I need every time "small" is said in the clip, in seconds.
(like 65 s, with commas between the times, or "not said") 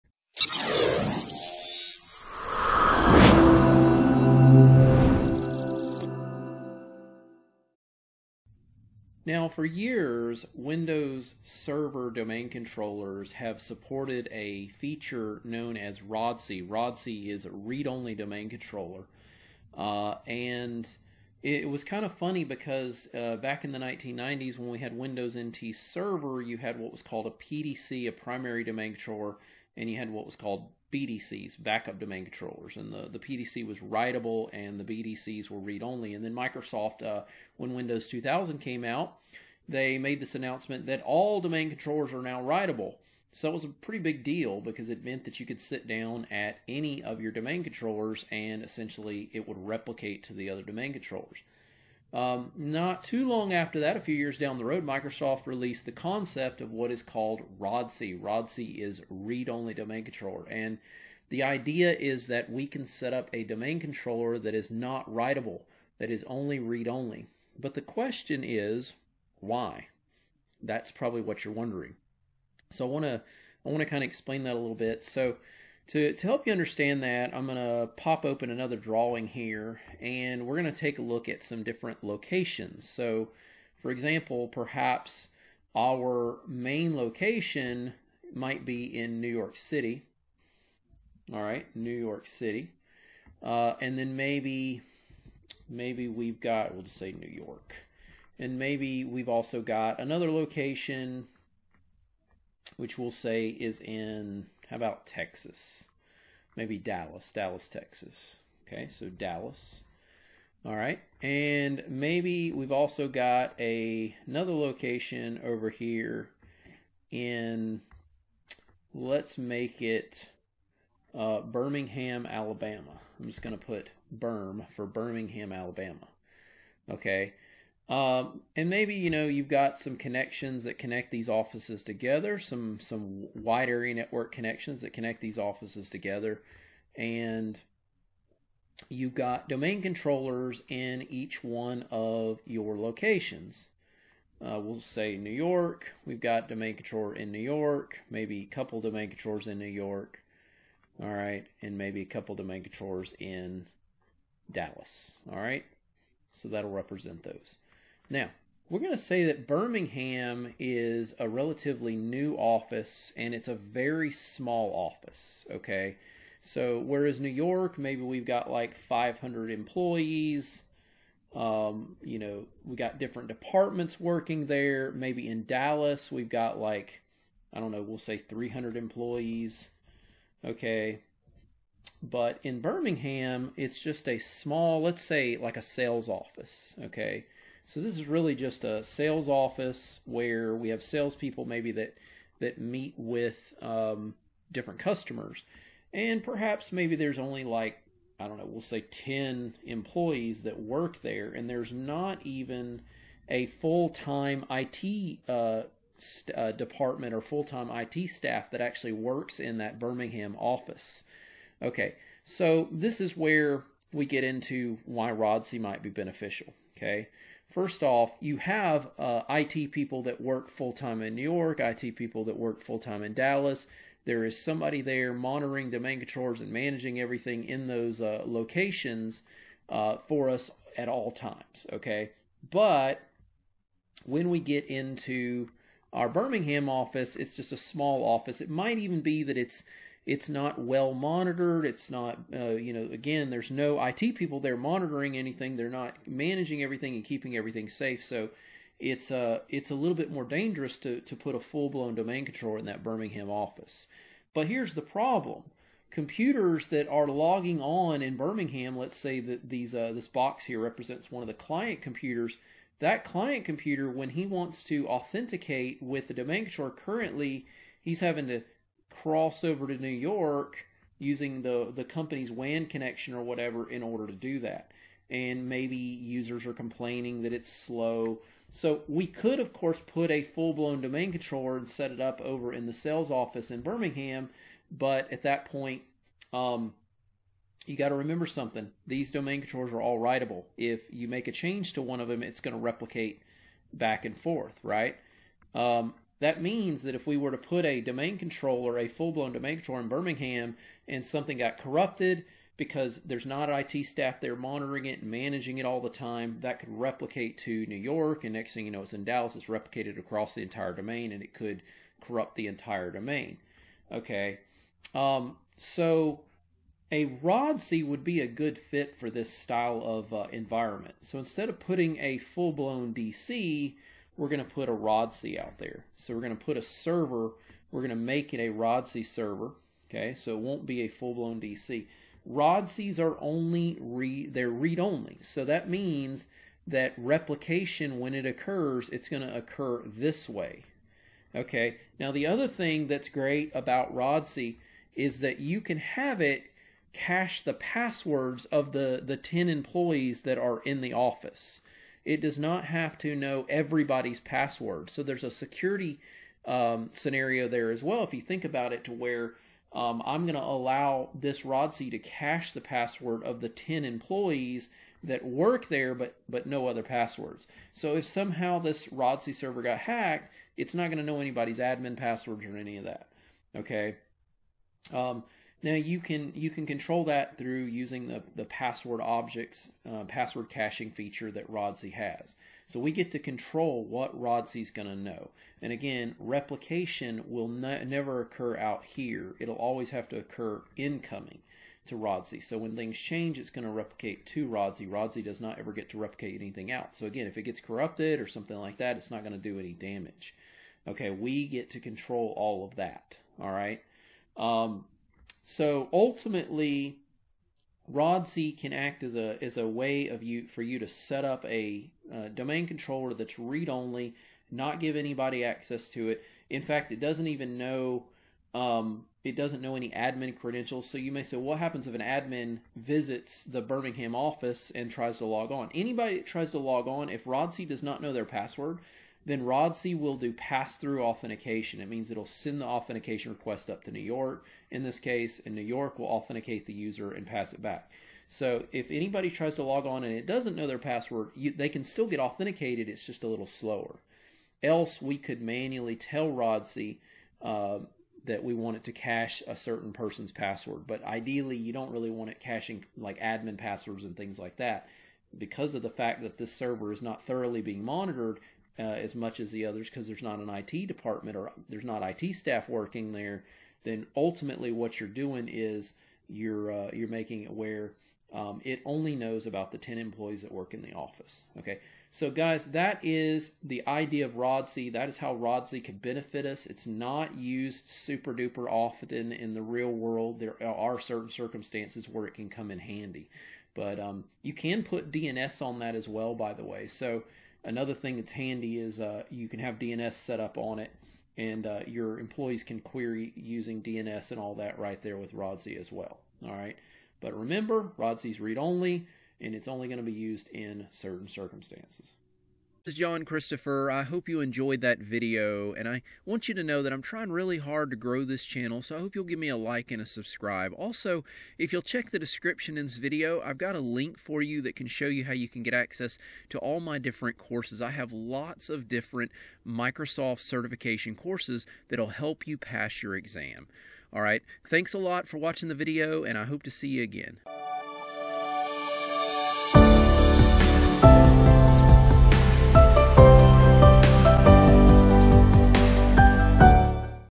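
164 s, 184 s, 237 s.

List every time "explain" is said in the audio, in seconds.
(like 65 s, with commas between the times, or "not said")
74 s.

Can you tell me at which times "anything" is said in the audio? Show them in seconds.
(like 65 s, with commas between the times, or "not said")
245 s, 396 s.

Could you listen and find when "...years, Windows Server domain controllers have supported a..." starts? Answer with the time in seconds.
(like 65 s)
9 s.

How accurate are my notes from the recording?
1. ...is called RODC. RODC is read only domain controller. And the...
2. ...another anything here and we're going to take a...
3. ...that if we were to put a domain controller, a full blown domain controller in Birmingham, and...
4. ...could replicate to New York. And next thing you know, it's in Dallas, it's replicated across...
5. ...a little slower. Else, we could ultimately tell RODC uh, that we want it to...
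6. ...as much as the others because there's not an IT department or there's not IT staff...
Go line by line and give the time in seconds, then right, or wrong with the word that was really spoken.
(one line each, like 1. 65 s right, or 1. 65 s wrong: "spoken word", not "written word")
1. 56 s right
2. 78 s wrong: "drawing", not "anything"
3. 296 s right
4. 306 s right
5. 443 s wrong: "manually", not "ultimately"
6. 458 s right.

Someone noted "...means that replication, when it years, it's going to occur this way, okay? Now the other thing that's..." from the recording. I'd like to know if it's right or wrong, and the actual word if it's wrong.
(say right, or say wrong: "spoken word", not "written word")
wrong: "occurs", not "years".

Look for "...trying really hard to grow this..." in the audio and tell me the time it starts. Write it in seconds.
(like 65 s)
507 s.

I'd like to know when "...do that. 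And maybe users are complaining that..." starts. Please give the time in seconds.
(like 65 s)
274 s.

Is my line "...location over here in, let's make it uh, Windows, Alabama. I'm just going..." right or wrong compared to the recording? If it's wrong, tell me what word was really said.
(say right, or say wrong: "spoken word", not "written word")
wrong: "Birmingham", not "Windows".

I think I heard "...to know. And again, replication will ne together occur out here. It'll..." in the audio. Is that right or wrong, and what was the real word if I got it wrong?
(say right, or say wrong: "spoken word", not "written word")
wrong: "never", not "together".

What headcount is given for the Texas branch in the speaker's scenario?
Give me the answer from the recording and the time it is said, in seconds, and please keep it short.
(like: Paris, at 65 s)
300, at 178 s.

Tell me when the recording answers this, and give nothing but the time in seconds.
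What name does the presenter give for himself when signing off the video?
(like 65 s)
502 s.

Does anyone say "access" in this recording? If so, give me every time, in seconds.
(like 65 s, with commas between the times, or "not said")
415 s, 515 s.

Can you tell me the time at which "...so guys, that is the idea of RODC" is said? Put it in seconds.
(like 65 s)
472 s.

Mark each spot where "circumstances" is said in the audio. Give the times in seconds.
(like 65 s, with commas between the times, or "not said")
481 s, 501 s.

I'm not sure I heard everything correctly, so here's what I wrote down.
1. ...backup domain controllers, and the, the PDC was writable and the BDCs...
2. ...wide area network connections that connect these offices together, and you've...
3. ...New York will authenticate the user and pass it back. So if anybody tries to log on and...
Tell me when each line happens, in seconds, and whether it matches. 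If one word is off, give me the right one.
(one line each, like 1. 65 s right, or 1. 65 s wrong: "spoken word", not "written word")
1. 31 s right
2. 133 s right
3. 435 s right.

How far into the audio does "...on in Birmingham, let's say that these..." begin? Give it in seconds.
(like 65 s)
257 s.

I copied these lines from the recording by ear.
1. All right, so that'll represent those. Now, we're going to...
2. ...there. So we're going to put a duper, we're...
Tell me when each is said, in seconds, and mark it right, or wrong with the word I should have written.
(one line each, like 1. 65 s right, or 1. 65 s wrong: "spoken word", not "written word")
1. 155 s right
2. 325 s wrong: "server", not "duper".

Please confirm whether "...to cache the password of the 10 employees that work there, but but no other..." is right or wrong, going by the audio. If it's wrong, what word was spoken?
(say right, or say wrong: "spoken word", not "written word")
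right.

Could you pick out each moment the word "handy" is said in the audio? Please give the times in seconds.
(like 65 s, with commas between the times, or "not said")
482 s, 488 s.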